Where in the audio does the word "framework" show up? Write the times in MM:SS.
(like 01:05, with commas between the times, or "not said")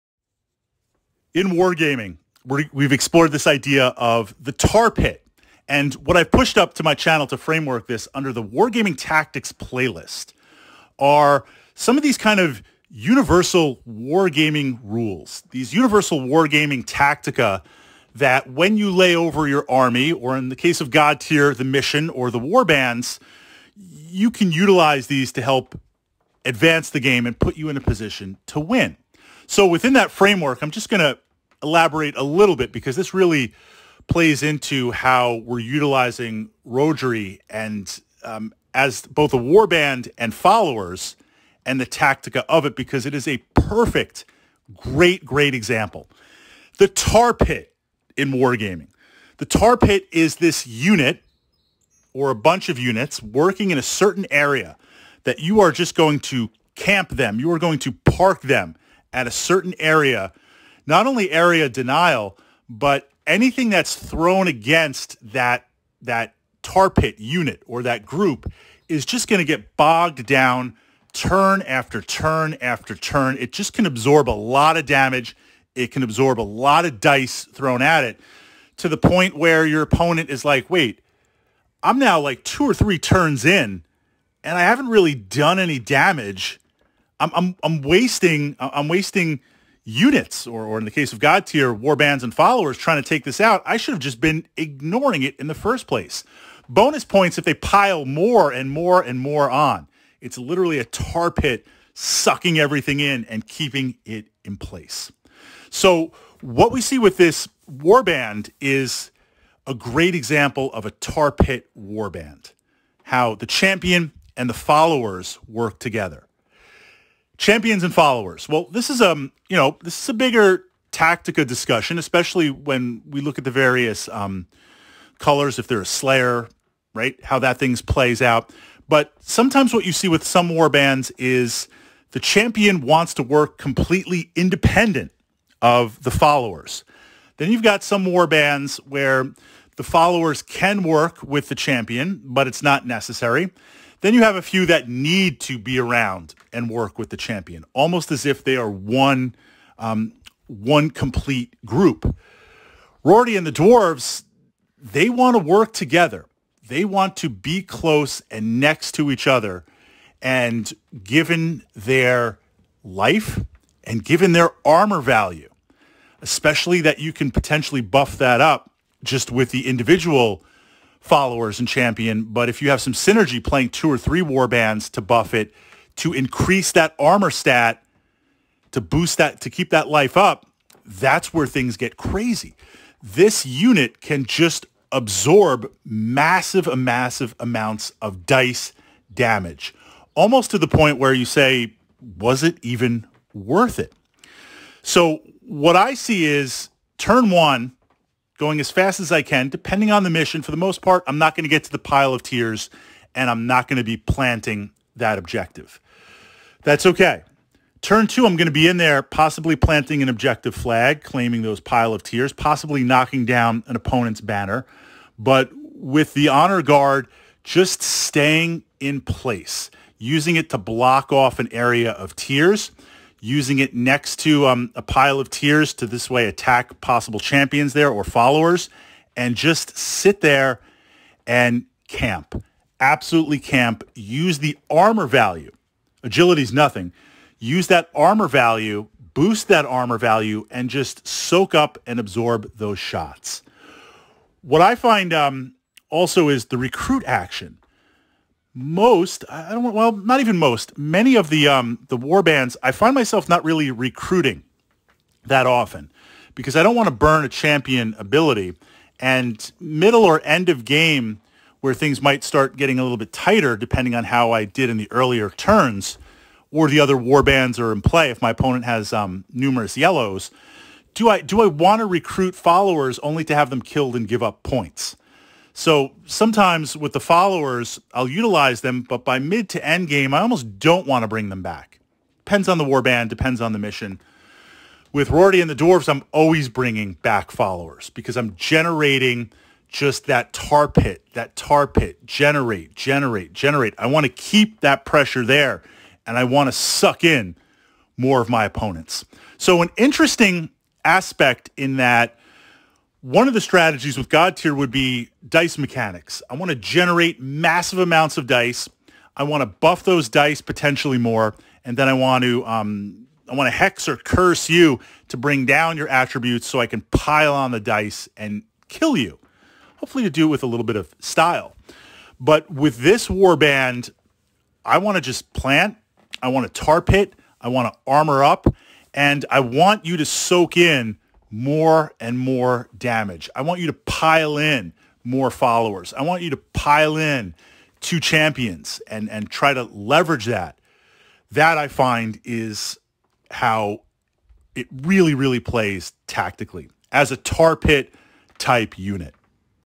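00:07, 00:30.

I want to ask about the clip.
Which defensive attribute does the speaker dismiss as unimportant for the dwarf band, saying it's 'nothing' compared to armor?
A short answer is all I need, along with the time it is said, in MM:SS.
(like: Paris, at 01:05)
Agility, at 03:56.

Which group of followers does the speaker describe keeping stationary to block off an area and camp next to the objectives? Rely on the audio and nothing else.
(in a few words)
honor guard.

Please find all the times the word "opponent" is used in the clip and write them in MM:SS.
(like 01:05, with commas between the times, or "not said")
01:19, 03:33, 04:28, 04:58.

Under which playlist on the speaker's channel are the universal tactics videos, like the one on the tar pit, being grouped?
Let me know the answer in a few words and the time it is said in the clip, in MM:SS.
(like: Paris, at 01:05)
wargaming tactics, at 00:08.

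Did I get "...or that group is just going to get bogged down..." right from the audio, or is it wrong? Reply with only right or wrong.
right.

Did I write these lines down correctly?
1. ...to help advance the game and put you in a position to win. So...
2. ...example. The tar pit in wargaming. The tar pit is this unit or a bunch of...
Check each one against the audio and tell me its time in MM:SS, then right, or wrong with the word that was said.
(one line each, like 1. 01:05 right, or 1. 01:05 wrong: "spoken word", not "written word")
1. 00:25 right
2. 00:45 right.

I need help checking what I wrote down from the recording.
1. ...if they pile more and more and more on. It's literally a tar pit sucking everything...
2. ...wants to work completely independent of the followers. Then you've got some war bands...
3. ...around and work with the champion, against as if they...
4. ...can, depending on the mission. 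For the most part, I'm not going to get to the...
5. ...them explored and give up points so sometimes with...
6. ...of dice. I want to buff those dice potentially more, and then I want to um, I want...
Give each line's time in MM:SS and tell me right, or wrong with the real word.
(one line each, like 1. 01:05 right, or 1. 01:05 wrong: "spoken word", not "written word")
1. 01:37 right
2. 02:12 right
3. 02:25 wrong: "almost", not "against"
4. 03:19 right
5. 04:33 wrong: "killed", not "explored"
6. 05:08 right.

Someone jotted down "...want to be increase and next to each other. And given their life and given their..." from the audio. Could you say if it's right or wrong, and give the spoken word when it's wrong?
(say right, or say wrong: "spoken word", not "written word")
wrong: "close", not "increase".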